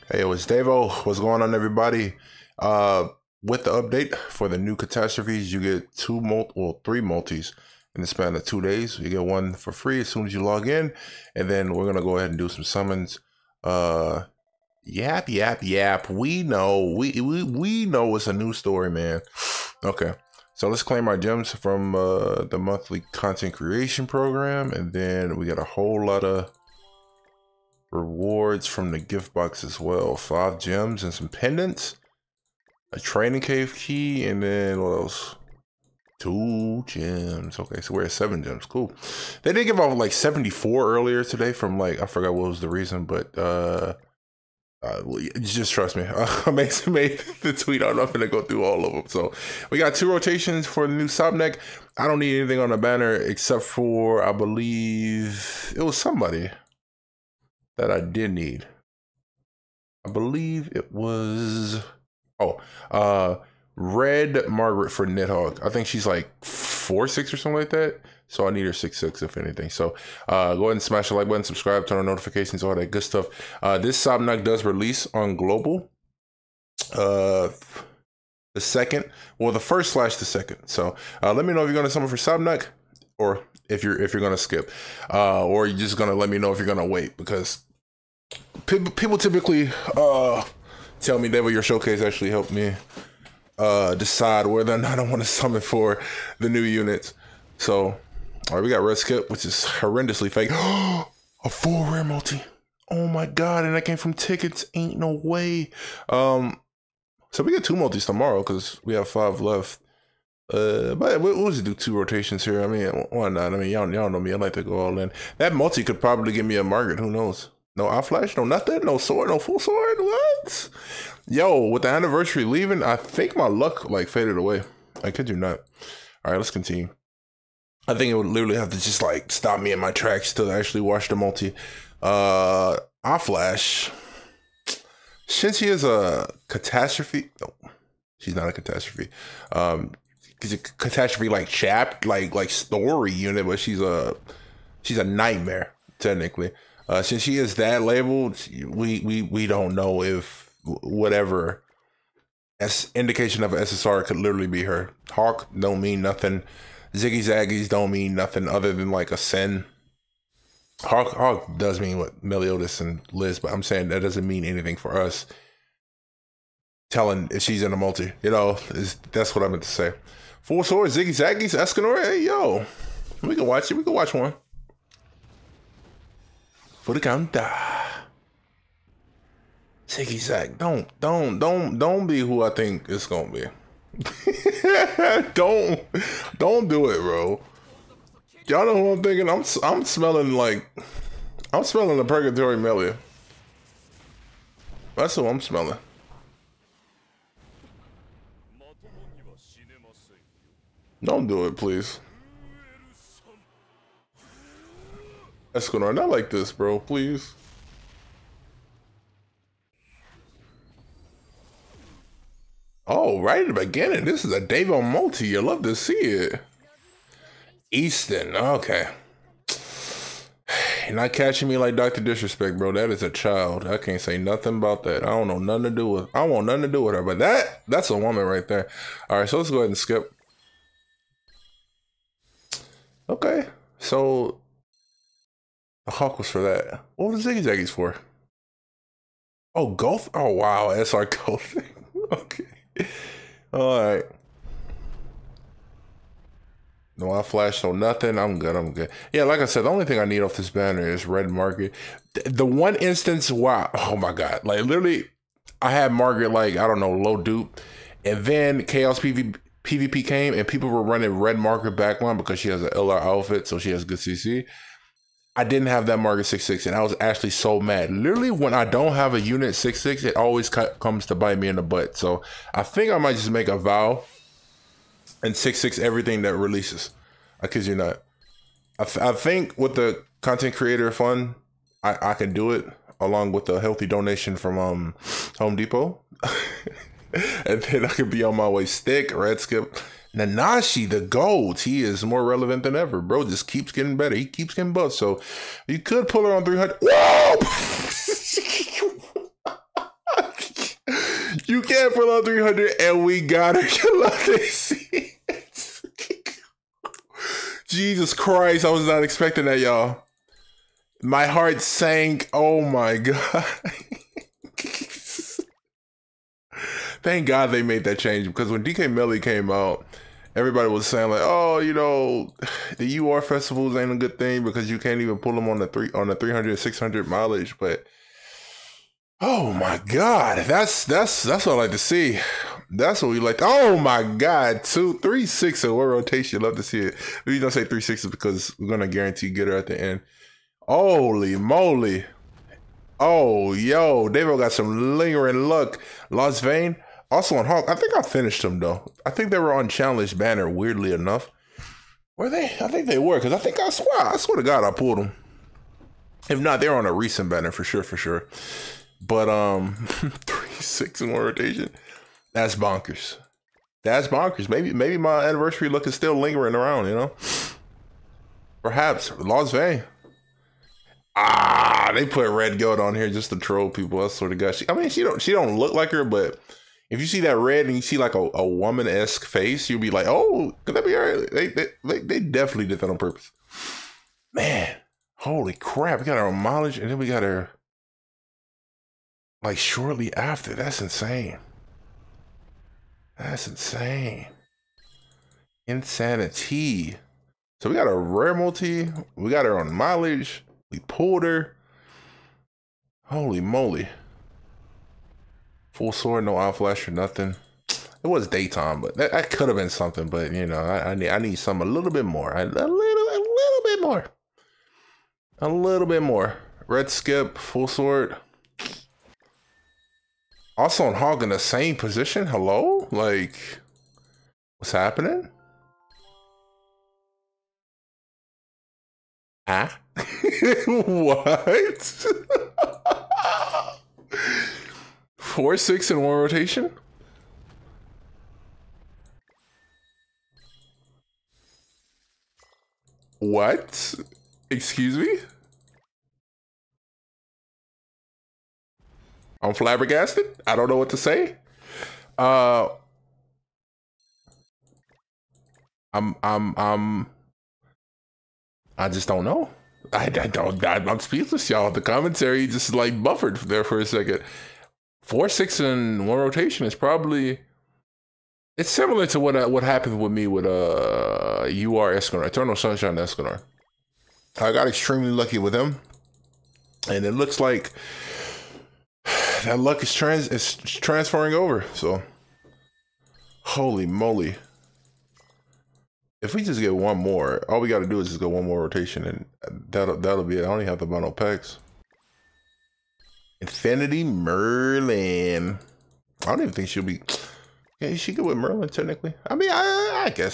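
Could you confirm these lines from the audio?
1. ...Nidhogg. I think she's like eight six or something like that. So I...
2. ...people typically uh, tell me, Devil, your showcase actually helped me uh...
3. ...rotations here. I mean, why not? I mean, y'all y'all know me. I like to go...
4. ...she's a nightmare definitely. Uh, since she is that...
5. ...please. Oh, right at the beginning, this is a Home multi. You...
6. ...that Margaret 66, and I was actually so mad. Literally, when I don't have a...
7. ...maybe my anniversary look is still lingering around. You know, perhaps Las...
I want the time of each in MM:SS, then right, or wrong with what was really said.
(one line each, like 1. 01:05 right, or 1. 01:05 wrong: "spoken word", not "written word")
1. 01:05 wrong: "four", not "eight"
2. 01:28 right
3. 01:51 right
4. 02:24 wrong: "technically", not "definitely"
5. 03:26 wrong: "Davon", not "Home"
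6. 04:25 right
7. 06:04 right.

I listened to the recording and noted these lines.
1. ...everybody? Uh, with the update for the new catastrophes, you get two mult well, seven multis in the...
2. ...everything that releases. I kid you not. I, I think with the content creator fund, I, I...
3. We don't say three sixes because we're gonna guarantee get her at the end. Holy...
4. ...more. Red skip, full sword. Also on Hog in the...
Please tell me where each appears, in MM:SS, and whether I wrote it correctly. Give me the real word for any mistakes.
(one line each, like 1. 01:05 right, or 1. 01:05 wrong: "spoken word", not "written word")
1. 00:01 wrong: "three", not "seven"
2. 04:35 right
3. 05:37 right
4. 06:56 right.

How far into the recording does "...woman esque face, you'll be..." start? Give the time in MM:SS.
06:18.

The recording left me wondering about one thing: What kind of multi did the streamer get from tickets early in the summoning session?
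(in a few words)
full rare multi.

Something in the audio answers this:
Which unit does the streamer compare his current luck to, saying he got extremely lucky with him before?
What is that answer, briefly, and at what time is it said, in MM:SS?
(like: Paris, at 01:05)
Eternal Sunshine Escanor, at 07:52.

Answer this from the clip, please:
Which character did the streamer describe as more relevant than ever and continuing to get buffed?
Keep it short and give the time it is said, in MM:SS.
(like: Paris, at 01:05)
Nanashi, at 04:50.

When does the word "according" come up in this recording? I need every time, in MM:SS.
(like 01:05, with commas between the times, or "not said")
not said.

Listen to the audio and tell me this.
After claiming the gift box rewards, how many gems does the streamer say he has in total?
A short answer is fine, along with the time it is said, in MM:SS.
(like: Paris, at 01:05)
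7, at 00:38.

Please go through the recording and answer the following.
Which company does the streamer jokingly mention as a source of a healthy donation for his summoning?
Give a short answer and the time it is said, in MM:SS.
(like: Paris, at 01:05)
Home Depot, at 04:45.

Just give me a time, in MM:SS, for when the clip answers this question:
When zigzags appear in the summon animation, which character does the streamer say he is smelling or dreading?
03:12.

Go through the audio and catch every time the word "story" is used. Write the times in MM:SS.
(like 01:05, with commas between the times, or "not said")
00:18, 02:22.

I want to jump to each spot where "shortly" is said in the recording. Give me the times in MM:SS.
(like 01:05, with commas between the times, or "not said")
06:29.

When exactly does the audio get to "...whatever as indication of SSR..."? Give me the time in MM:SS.
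02:30.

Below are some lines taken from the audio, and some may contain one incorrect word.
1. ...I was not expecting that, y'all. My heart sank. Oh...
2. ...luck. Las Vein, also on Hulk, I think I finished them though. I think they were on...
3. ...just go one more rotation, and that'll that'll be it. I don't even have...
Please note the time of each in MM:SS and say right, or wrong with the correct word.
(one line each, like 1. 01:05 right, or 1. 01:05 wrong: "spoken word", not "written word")
1. 05:08 right
2. 05:45 right
3. 08:08 right.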